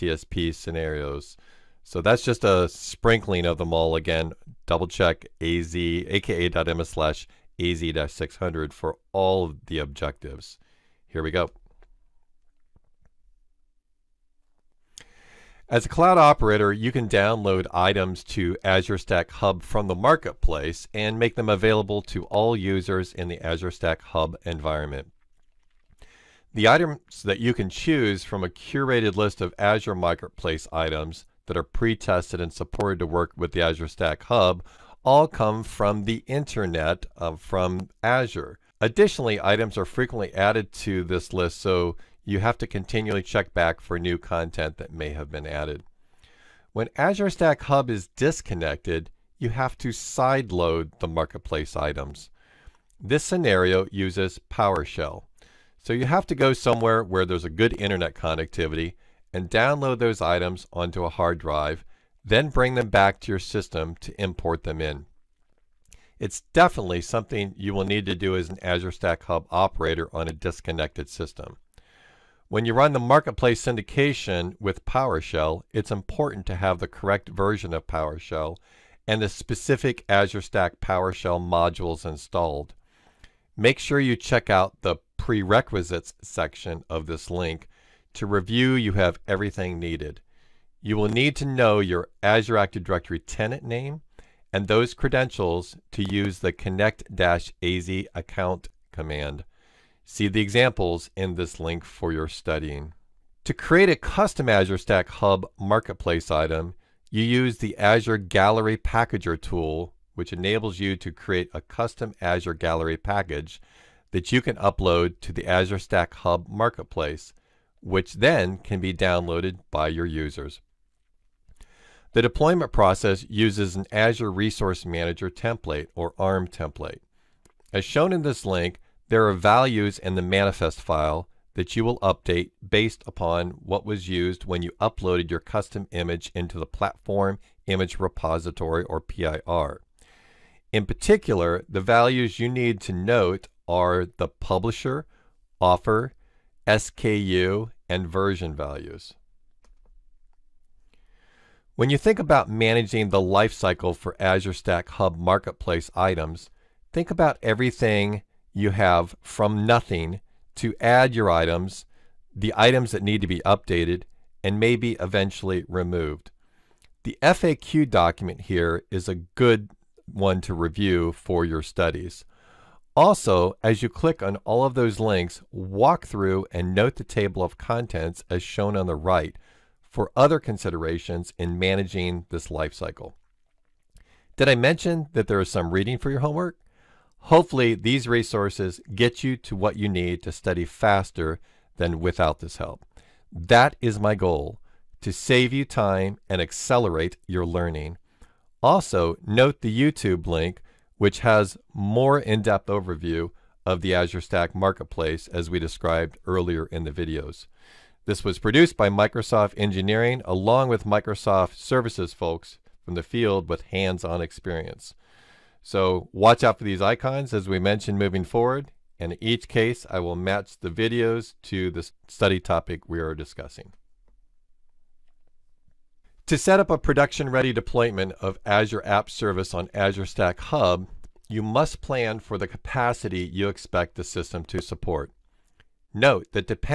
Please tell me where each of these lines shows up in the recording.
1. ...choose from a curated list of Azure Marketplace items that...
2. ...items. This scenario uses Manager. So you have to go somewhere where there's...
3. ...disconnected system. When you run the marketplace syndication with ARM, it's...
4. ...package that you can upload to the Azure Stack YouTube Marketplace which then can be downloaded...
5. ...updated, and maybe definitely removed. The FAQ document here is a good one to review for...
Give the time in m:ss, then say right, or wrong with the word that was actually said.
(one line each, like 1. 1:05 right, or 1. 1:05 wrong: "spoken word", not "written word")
1. 0:27 right
2. 0:51 wrong: "PowerShell", not "Manager"
3. 1:10 wrong: "PowerShell", not "ARM"
4. 1:52 wrong: "Hub", not "YouTube"
5. 2:43 wrong: "eventually", not "definitely".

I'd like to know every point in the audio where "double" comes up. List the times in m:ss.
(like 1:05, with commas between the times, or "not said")
0:04.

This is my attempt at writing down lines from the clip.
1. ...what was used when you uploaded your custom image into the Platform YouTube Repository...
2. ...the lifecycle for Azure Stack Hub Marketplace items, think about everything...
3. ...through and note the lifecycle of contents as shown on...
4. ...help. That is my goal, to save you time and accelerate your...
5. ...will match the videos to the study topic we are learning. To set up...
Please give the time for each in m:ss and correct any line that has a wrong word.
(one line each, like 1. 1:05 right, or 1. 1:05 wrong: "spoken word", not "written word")
1. 2:13 wrong: "Image", not "YouTube"
2. 2:33 right
3. 2:56 wrong: "table", not "lifecycle"
4. 3:12 right
5. 3:40 wrong: "discussing", not "learning".